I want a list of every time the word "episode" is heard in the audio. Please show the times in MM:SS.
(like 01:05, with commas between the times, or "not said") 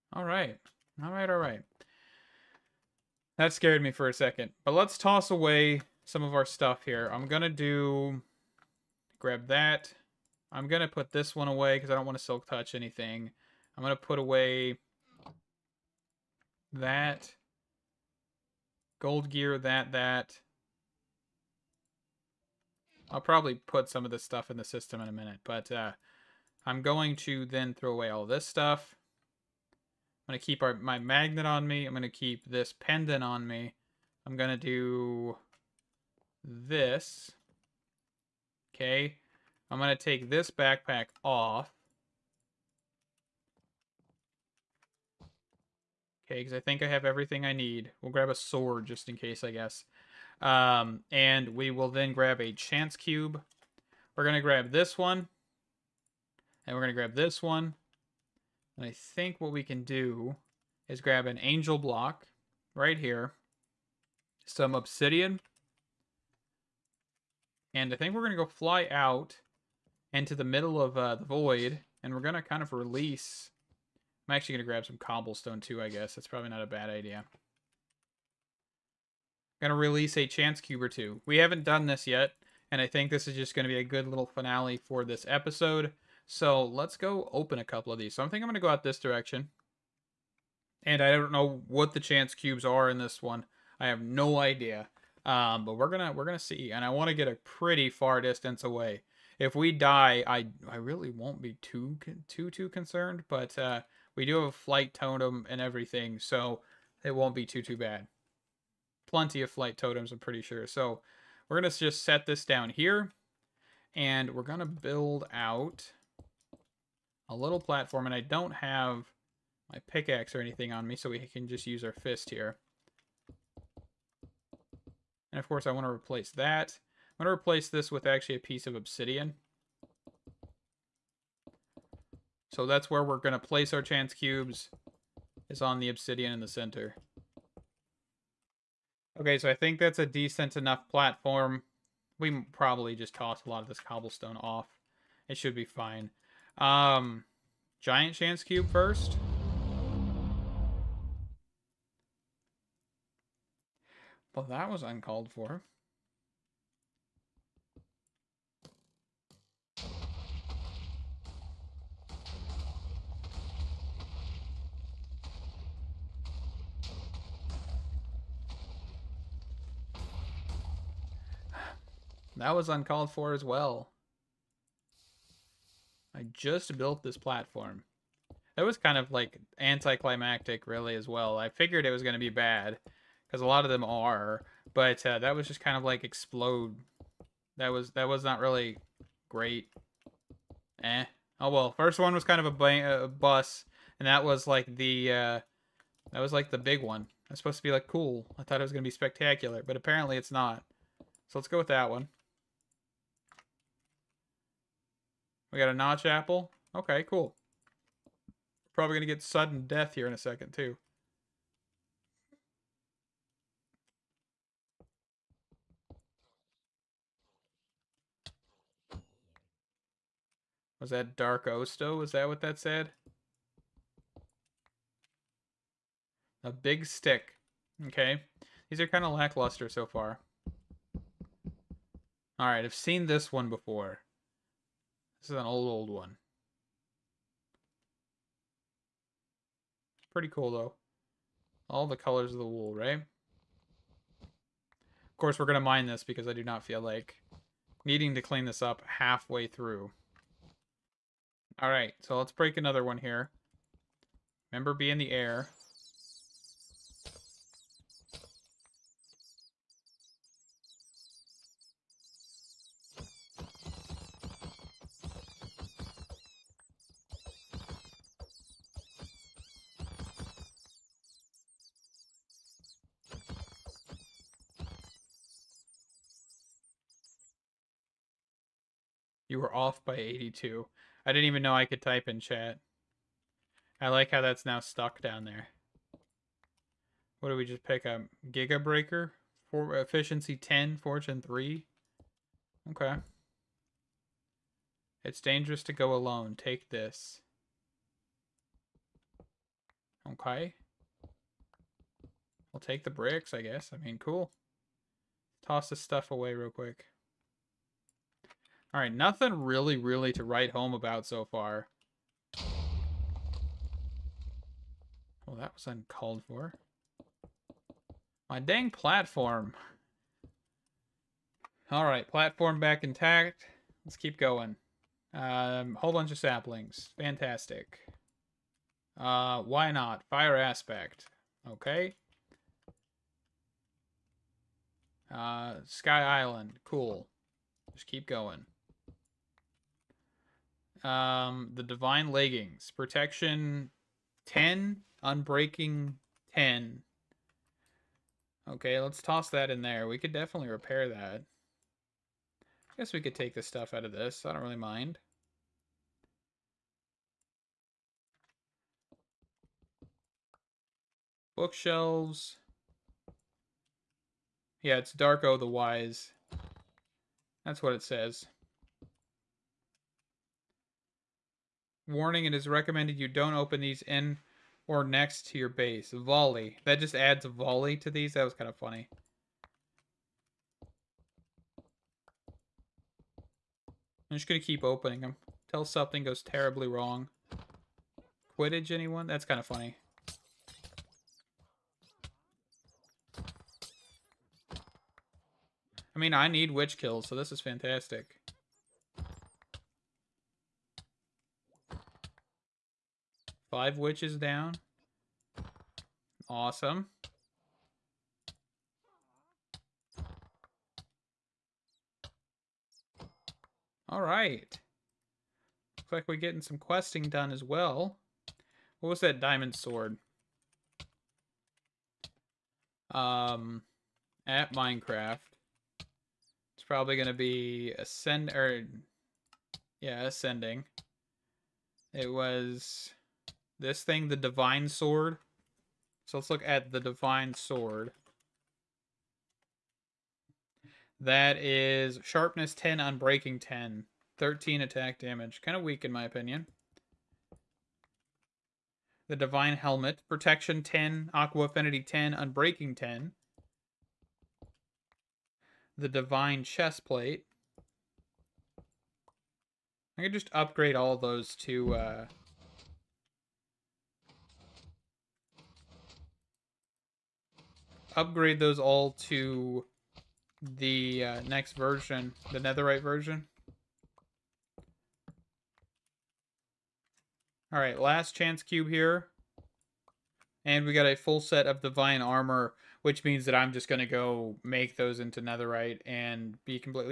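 01:25.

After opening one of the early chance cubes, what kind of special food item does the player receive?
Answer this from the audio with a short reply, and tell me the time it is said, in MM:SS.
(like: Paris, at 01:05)
Notch apple, at 03:25.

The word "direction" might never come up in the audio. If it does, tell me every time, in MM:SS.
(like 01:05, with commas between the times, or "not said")
01:28.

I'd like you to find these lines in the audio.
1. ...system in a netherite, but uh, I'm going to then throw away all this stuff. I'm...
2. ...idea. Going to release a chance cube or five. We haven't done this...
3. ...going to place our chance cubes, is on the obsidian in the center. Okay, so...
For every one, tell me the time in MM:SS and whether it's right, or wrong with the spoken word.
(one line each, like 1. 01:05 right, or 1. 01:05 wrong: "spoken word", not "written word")
1. 00:24 wrong: "minute", not "netherite"
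2. 01:16 wrong: "two", not "five"
3. 02:13 right.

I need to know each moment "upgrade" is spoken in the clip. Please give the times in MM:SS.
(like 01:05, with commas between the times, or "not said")
07:40, 07:47.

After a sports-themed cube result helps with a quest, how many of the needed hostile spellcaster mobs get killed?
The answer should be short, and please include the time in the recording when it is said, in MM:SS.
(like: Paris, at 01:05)
5, at 06:43.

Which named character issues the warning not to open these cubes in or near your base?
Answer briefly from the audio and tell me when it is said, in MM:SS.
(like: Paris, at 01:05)
Darko the Wise, at 06:04.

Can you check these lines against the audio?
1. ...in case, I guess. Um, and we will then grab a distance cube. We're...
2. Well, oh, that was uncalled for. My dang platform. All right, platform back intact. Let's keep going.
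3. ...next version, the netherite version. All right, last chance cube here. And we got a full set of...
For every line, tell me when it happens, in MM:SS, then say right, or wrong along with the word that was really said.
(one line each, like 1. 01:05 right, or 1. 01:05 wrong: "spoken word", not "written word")
1. 00:49 wrong: "chance", not "distance"
2. 05:15 right
3. 07:51 right.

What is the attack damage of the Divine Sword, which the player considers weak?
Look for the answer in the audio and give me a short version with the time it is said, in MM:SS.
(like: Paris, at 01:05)
13, at 07:24.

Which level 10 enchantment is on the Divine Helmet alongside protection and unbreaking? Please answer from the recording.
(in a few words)
Aqua affinity.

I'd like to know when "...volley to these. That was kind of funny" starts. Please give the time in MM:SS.
06:17.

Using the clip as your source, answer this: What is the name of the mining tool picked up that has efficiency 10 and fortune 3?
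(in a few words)
Giga Breaker.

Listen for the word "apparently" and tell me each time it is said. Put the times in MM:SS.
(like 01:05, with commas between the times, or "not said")
03:19.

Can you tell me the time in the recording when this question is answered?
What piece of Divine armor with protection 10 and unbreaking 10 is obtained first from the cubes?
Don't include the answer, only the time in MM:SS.
05:41.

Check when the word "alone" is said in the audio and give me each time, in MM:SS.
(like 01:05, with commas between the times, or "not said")
04:55.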